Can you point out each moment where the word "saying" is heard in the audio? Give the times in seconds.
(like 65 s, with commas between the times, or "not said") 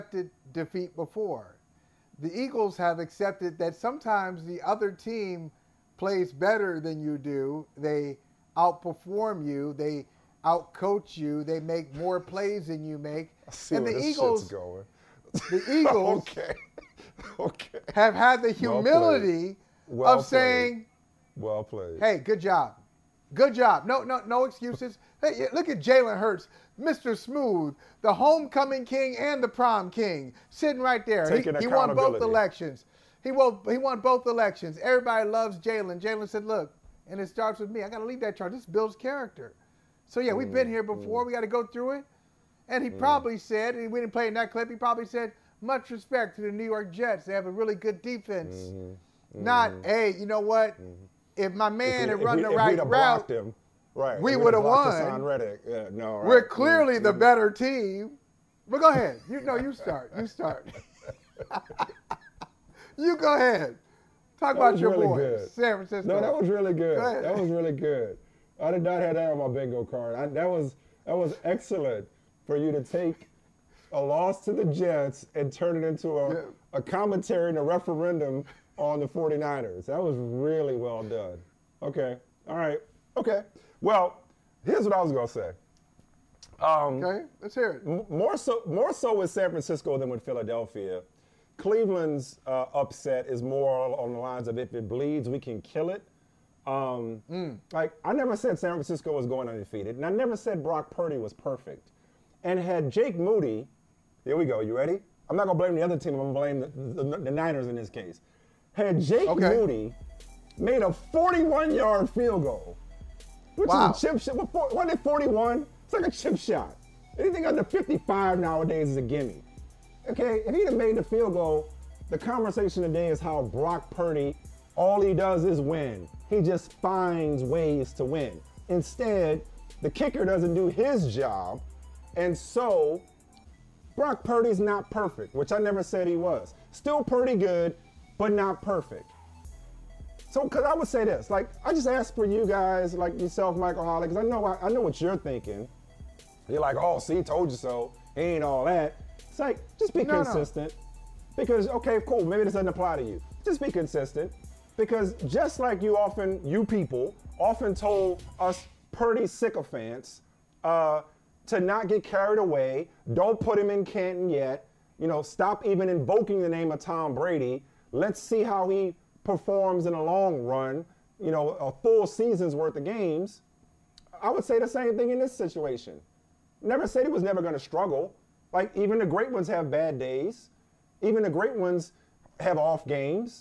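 20 s.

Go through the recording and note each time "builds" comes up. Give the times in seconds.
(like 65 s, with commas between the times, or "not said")
38 s.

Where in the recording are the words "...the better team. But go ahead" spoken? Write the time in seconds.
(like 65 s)
56 s.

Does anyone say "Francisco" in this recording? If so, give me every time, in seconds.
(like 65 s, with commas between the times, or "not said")
65 s, 89 s, 98 s.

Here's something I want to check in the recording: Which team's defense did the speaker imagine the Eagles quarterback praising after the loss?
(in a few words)
New York Jets.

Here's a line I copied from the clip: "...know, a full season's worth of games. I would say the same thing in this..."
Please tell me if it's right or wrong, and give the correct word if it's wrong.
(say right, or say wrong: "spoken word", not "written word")
right.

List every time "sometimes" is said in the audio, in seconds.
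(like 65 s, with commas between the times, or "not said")
3 s.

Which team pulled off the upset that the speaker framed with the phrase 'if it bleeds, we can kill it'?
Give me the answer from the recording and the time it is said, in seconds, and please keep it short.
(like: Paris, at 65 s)
Cleveland, at 91 s.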